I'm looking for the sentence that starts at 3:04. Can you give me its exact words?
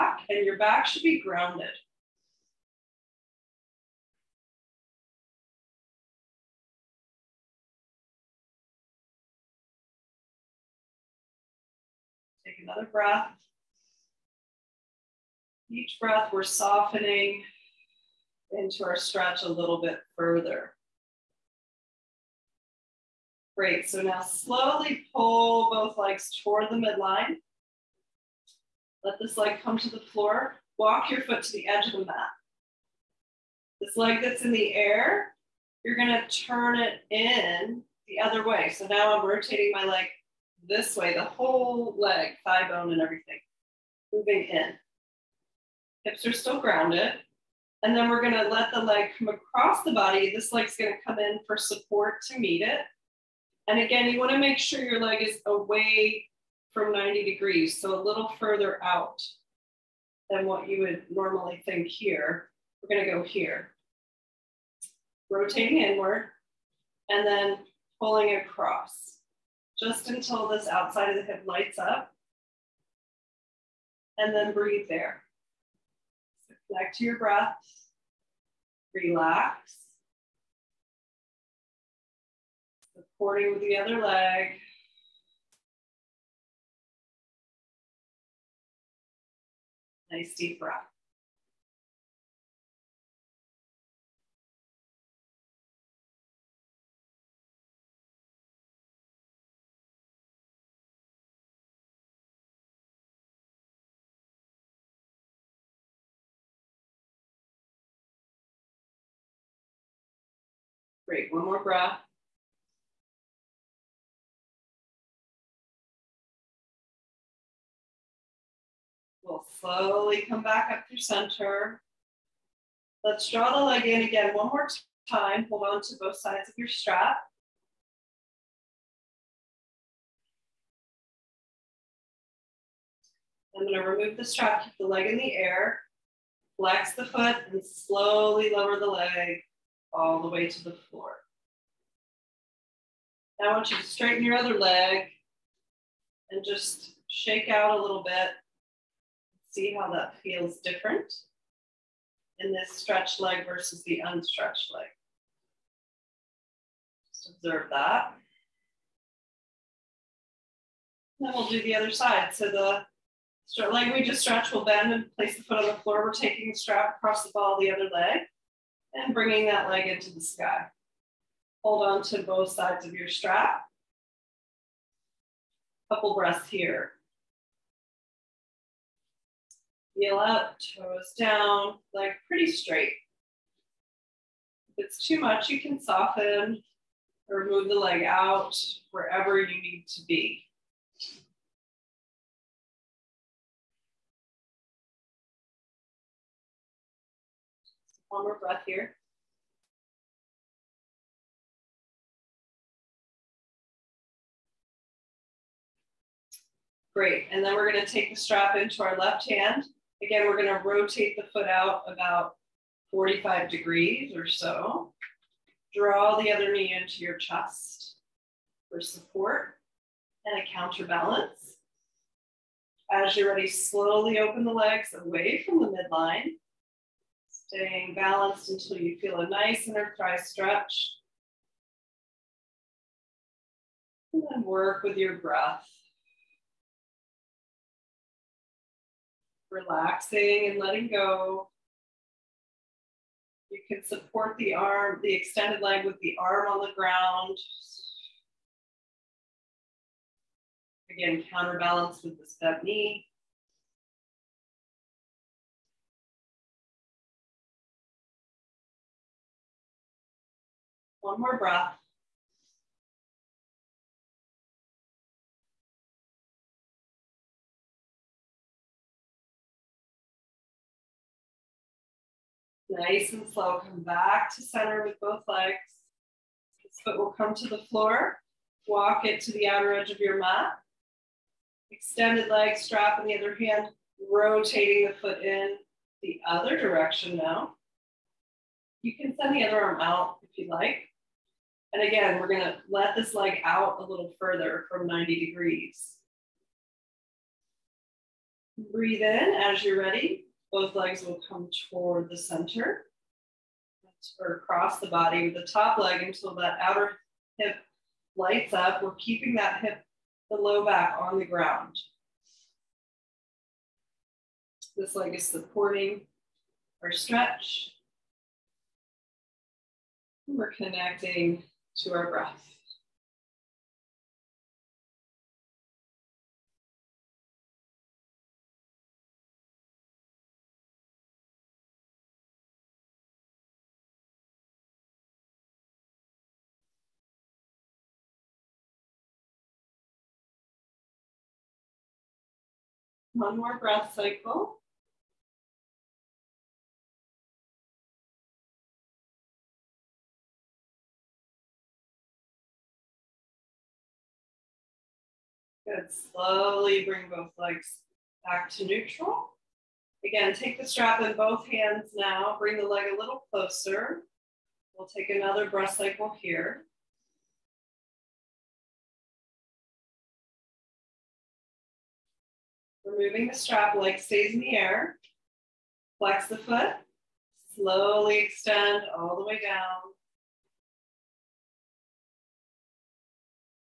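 If it's too much, you can soften or move the leg out wherever you need to be.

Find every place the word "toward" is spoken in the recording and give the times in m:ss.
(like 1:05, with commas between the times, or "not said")
0:26, 5:01.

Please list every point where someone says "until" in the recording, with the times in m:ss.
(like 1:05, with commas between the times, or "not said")
1:10, 3:48, 5:06.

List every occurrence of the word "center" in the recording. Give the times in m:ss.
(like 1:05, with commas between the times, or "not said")
2:00, 4:34, 5:02.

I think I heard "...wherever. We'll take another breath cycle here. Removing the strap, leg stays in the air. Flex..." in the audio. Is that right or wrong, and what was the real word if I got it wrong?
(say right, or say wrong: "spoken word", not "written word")
wrong: "closer", not "wherever".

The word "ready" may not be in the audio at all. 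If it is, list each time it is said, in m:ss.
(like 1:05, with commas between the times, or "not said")
3:43, 4:59.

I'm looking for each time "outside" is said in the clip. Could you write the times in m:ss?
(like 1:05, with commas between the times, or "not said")
1:10.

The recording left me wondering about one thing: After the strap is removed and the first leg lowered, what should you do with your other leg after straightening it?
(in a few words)
shake out.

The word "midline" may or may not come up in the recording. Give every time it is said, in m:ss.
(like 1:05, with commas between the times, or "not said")
0:26, 3:45.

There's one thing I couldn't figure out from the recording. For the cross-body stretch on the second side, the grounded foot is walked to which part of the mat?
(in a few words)
outer edge.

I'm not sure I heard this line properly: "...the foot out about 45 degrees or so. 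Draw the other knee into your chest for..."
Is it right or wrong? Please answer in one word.
right.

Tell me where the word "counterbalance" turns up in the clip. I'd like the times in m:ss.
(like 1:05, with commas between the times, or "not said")
3:40, 4:11.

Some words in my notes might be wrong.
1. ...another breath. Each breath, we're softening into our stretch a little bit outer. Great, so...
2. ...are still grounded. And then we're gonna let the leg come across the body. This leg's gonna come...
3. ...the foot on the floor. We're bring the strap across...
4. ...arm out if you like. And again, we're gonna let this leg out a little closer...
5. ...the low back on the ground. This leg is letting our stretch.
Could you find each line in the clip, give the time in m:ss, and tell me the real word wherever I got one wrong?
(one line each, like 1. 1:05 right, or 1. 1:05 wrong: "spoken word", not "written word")
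1. 0:12 wrong: "further", not "outer"
2. 0:46 right
3. 2:45 wrong: "taking", not "bring"
4. 4:49 wrong: "further", not "closer"
5. 5:10 wrong: "supporting", not "letting".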